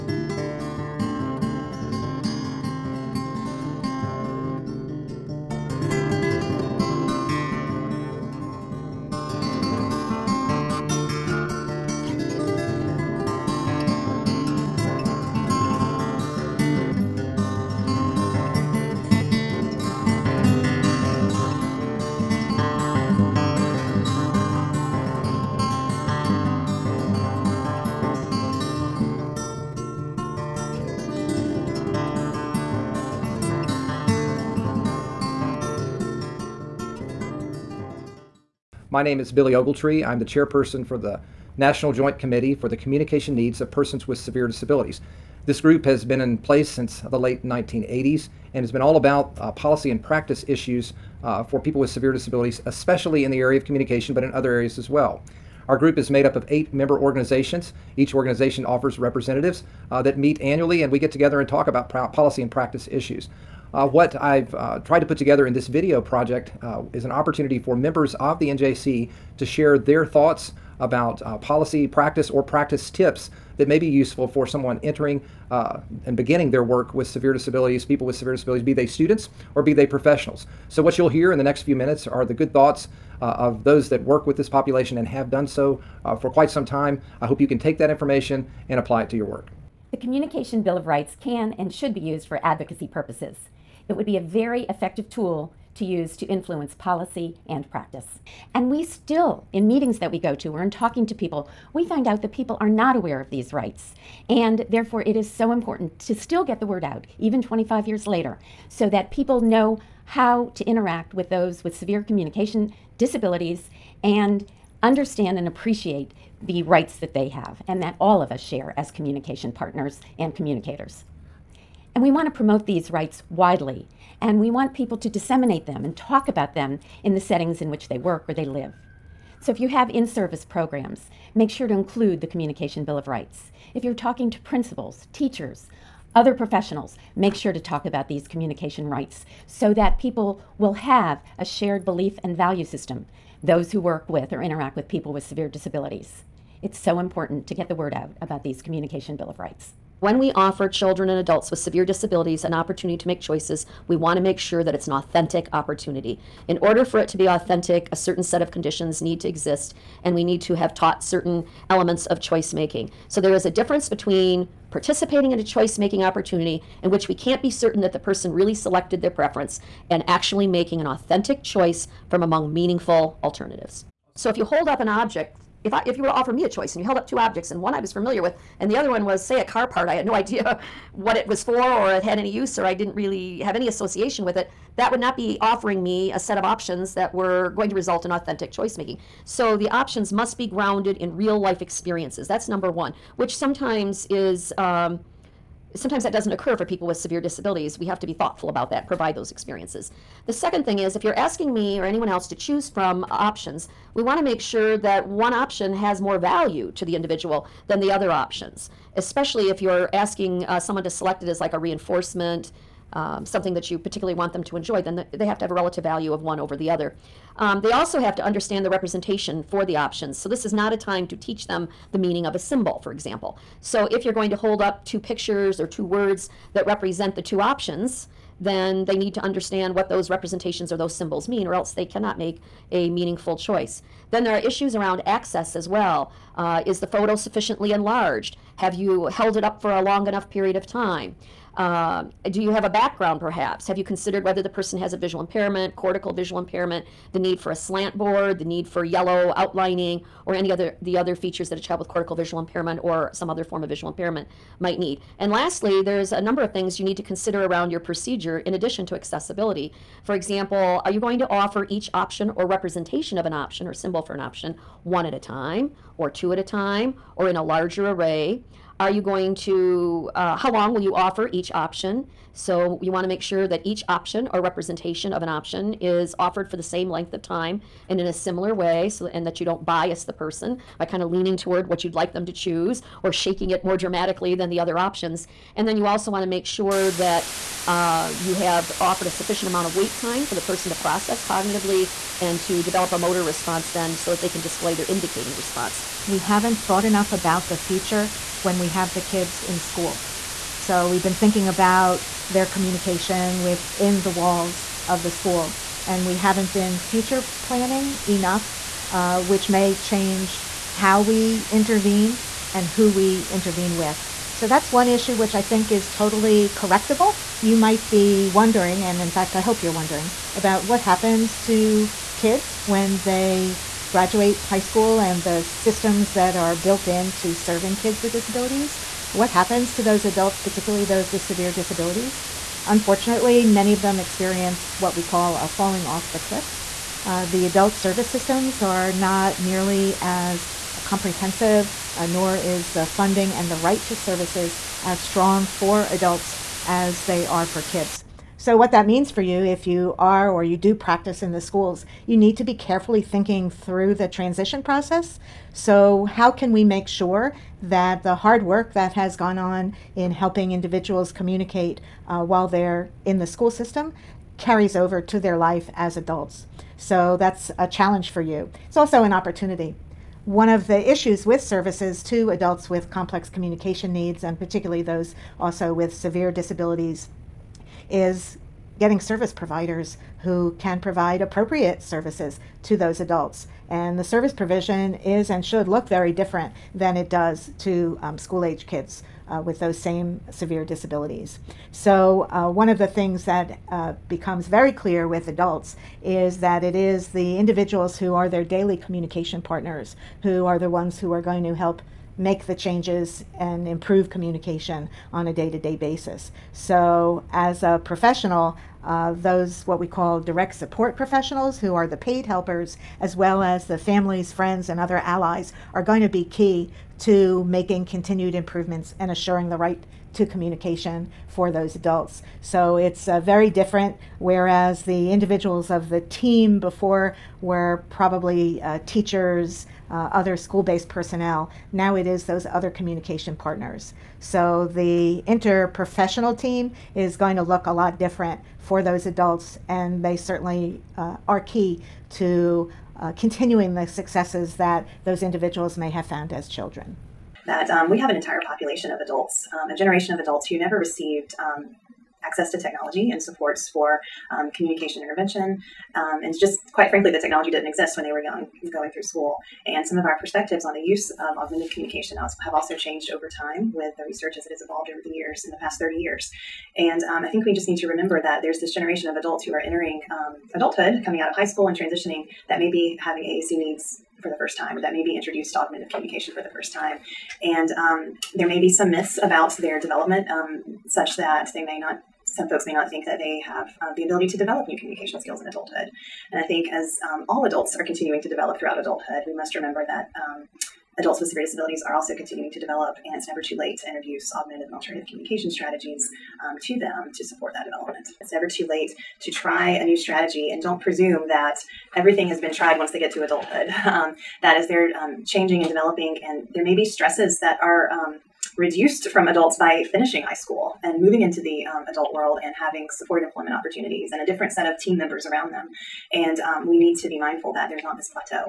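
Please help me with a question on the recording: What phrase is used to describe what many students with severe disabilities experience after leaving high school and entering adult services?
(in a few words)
falling off the cliff.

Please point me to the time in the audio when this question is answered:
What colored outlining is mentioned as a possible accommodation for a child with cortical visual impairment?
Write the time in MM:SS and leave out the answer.
04:08.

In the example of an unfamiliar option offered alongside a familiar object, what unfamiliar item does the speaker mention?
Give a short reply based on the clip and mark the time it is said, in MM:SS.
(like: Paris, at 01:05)
a car part, at 02:59.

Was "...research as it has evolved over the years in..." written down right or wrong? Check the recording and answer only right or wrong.
right.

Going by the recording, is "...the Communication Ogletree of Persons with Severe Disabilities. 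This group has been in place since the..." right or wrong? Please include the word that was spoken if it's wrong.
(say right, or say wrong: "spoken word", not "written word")
wrong: "Needs", not "Ogletree".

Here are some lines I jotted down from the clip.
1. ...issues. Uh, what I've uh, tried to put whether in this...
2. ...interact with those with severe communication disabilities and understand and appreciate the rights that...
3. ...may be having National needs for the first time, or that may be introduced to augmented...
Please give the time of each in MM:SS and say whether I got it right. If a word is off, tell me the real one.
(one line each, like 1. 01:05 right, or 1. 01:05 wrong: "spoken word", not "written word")
1. 01:02 wrong: "together", not "whether"
2. 01:50 right
3. 07:52 wrong: "AAC", not "National".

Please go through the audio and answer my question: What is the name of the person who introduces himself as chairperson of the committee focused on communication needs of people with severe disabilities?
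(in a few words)
Billy Ogletree.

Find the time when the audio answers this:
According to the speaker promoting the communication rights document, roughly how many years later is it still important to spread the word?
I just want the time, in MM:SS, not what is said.
01:47.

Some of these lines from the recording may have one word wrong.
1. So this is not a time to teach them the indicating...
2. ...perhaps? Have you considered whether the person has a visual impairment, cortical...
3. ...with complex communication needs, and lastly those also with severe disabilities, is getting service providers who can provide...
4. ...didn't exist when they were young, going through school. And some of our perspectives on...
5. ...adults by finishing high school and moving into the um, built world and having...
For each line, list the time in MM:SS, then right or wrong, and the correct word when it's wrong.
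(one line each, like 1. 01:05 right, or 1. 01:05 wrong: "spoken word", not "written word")
1. 03:40 wrong: "meaning", not "indicating"
2. 04:03 right
3. 06:12 wrong: "particularly", not "lastly"
4. 07:37 right
5. 08:29 wrong: "adult", not "built".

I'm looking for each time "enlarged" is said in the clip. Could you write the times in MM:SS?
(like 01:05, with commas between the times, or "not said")
03:57.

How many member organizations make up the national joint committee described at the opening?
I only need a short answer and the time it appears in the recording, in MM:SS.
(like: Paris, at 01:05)
8, at 00:56.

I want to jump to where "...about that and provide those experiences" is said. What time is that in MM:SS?
03:18.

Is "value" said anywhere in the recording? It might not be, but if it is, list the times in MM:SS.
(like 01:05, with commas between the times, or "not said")
02:22, 03:26, 03:35.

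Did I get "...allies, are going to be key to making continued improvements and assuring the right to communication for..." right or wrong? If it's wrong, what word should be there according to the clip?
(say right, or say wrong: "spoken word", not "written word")
right.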